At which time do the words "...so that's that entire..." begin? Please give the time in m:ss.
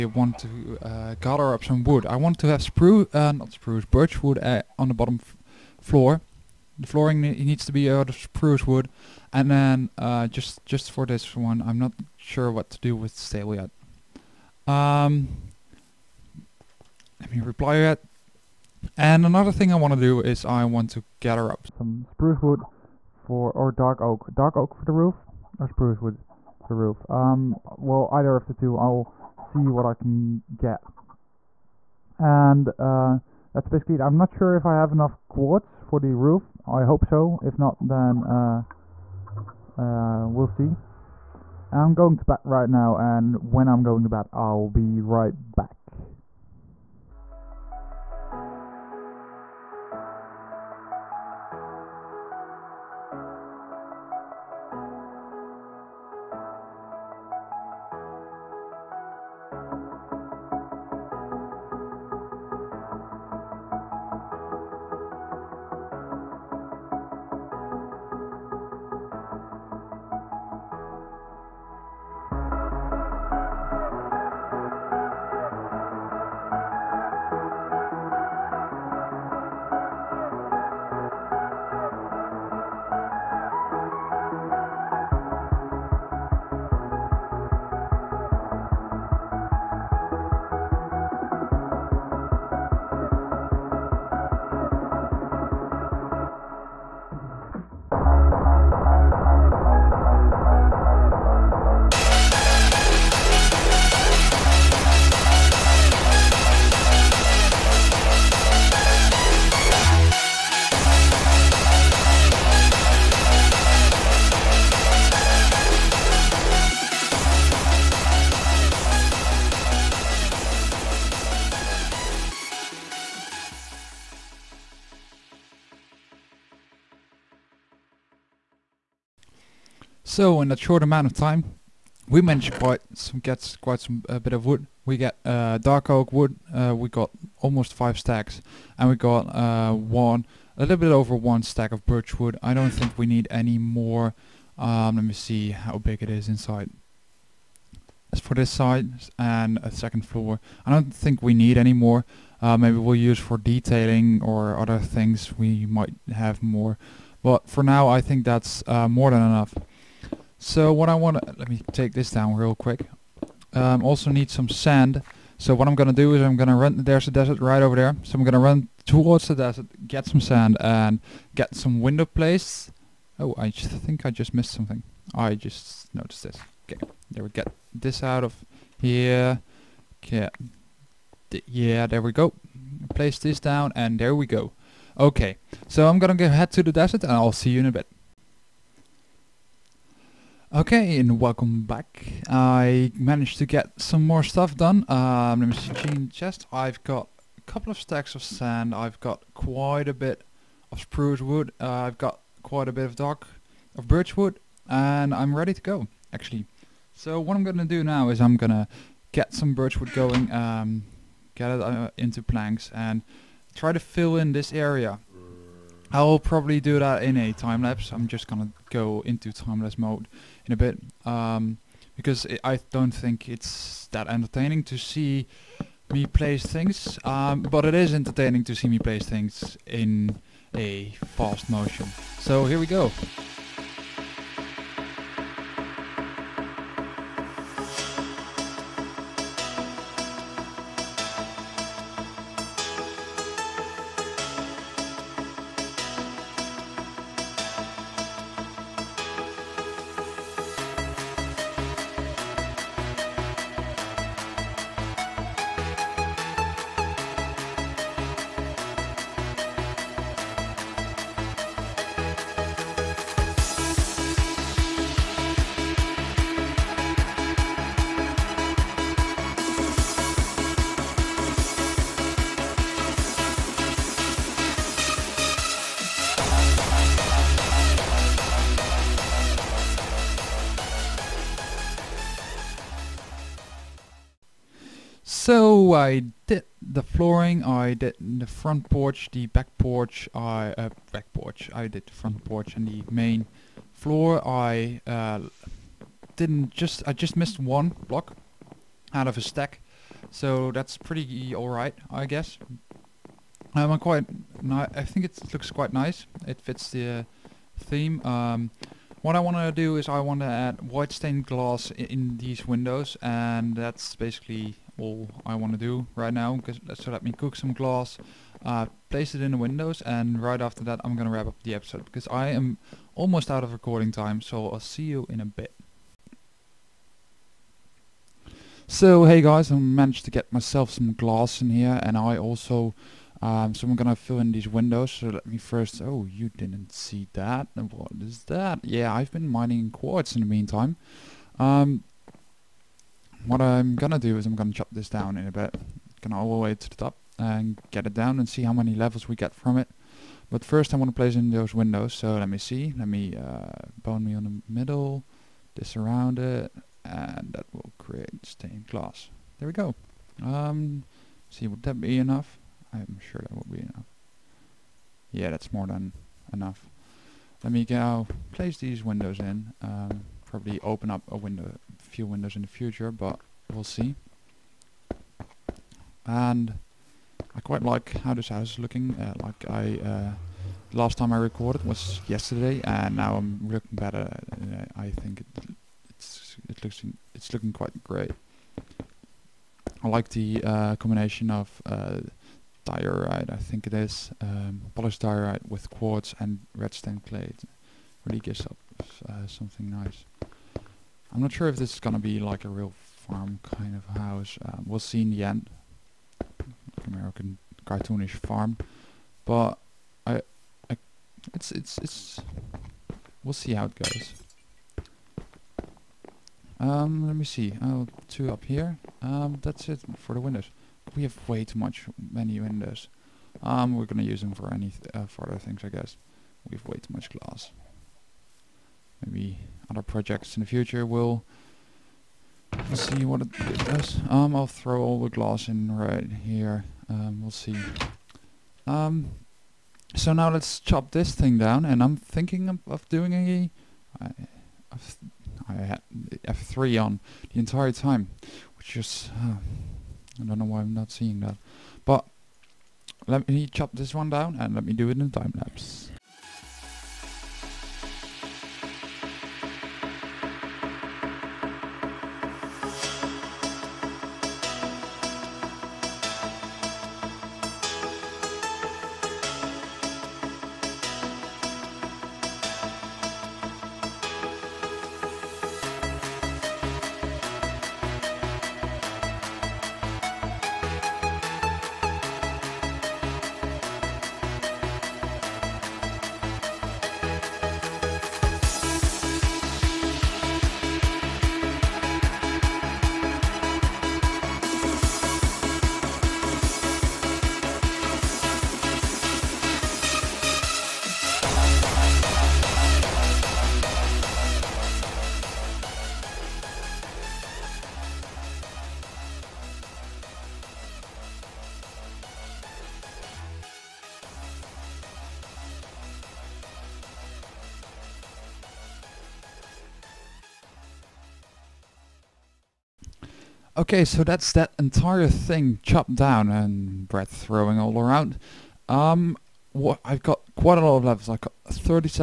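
8:43.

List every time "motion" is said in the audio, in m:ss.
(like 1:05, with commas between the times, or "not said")
3:51.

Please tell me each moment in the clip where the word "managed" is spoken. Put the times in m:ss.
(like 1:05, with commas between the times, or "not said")
2:12, 3:12, 5:29.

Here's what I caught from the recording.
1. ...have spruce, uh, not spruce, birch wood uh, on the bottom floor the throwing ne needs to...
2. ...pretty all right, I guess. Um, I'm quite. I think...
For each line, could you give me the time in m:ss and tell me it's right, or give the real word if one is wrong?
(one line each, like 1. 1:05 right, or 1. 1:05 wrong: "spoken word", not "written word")
1. 0:02 wrong: "flooring", not "throwing"
2. 5:00 right.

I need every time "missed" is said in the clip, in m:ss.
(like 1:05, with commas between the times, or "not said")
2:54, 4:57.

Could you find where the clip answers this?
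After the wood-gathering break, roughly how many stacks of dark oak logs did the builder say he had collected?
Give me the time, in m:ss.
2:17.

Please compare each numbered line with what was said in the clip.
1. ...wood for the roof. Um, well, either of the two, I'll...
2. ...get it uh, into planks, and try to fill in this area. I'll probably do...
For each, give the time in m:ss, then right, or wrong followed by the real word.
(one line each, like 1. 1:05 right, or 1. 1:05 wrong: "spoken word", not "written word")
1. 0:25 right
2. 3:31 right.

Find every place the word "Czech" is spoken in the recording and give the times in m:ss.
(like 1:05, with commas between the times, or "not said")
not said.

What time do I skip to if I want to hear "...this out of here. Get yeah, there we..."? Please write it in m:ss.
2:57.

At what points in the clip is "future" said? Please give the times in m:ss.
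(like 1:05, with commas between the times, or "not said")
6:12, 7:10.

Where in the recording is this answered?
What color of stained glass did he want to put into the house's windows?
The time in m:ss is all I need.
5:10.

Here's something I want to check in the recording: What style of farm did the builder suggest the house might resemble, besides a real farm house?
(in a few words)
American cartoonish farm.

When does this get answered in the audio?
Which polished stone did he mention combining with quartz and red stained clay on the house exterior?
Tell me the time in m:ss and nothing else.
6:34.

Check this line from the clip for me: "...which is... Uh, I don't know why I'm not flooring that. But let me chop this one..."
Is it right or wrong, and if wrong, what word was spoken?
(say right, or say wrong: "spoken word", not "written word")
wrong: "seeing", not "flooring".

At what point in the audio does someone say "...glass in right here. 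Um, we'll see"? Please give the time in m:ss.
7:15.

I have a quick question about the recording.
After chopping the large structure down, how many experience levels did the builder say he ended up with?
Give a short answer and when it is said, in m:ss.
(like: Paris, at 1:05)
37, at 8:51.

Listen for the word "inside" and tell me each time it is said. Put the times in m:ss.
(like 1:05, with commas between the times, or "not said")
2:26.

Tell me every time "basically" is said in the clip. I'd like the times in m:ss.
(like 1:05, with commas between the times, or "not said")
0:33, 5:13.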